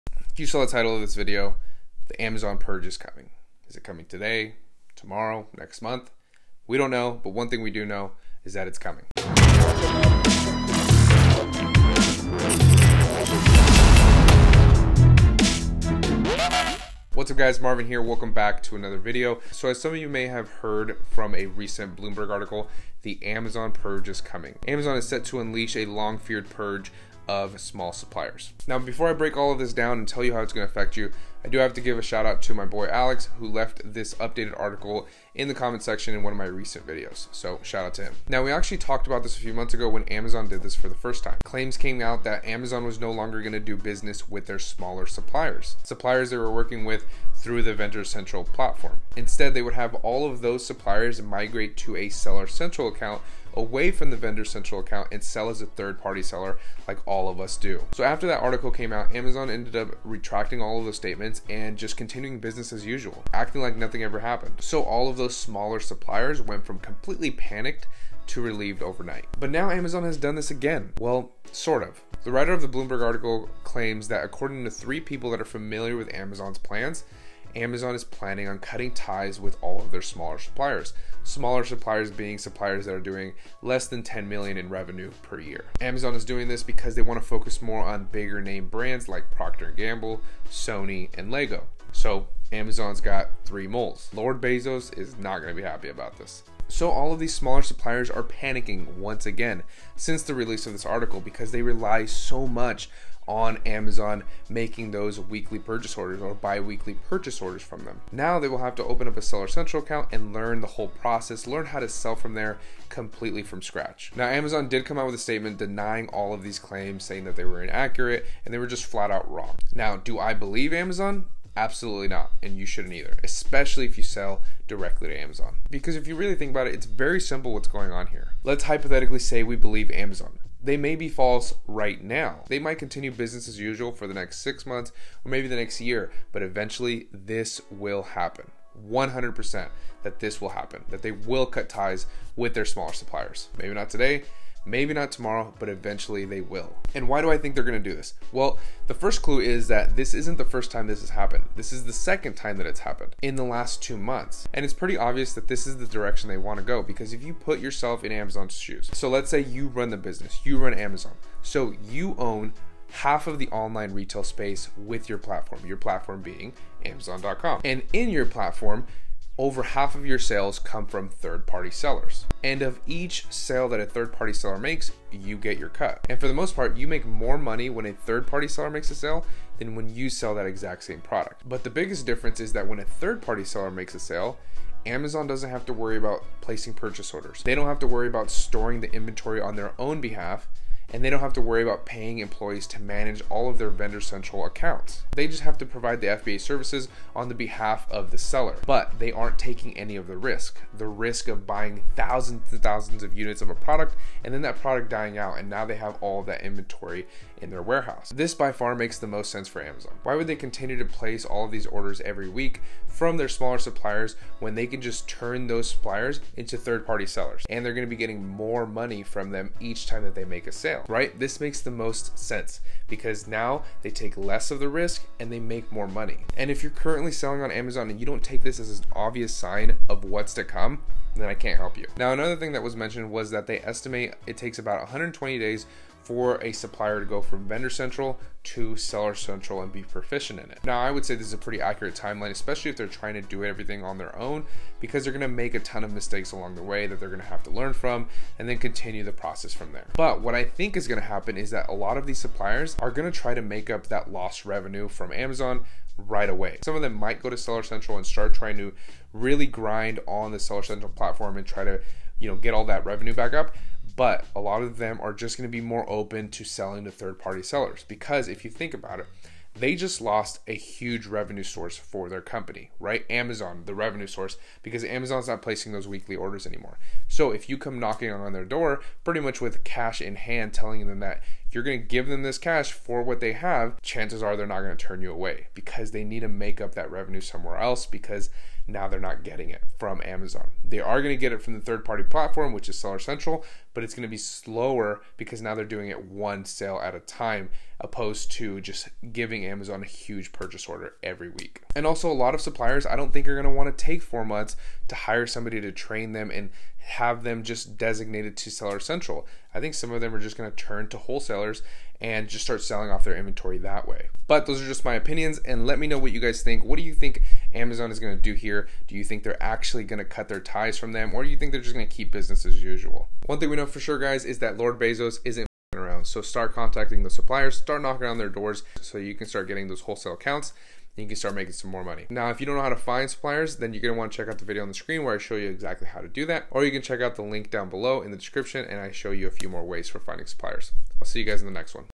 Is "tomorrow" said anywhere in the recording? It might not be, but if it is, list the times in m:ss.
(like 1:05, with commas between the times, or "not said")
0:04, 2:25.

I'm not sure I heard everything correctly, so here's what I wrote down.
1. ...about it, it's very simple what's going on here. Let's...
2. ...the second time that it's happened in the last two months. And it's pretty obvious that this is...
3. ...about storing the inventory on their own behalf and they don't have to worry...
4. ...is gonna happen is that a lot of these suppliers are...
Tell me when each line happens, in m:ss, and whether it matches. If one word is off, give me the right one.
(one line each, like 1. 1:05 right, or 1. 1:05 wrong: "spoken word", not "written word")
1. 2:06 right
2. 2:31 right
3. 3:08 right
4. 4:10 right.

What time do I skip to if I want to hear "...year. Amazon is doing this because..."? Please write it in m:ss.
1:25.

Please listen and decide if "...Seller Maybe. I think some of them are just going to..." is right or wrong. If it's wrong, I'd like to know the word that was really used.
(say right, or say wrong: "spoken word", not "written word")
wrong: "Central", not "Maybe".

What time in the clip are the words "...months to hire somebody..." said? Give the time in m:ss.
5:04.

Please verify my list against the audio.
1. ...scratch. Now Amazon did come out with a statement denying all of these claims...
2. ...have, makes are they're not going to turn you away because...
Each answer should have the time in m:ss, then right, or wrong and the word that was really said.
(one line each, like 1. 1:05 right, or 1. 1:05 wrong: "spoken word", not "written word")
1. 1:53 right
2. 4:43 wrong: "chances", not "makes".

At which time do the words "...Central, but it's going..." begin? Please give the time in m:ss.
4:52.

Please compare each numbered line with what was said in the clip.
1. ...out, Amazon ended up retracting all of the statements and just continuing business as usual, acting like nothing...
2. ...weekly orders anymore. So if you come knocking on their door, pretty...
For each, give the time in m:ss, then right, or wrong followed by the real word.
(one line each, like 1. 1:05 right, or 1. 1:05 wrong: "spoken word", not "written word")
1. 0:58 right
2. 4:35 right.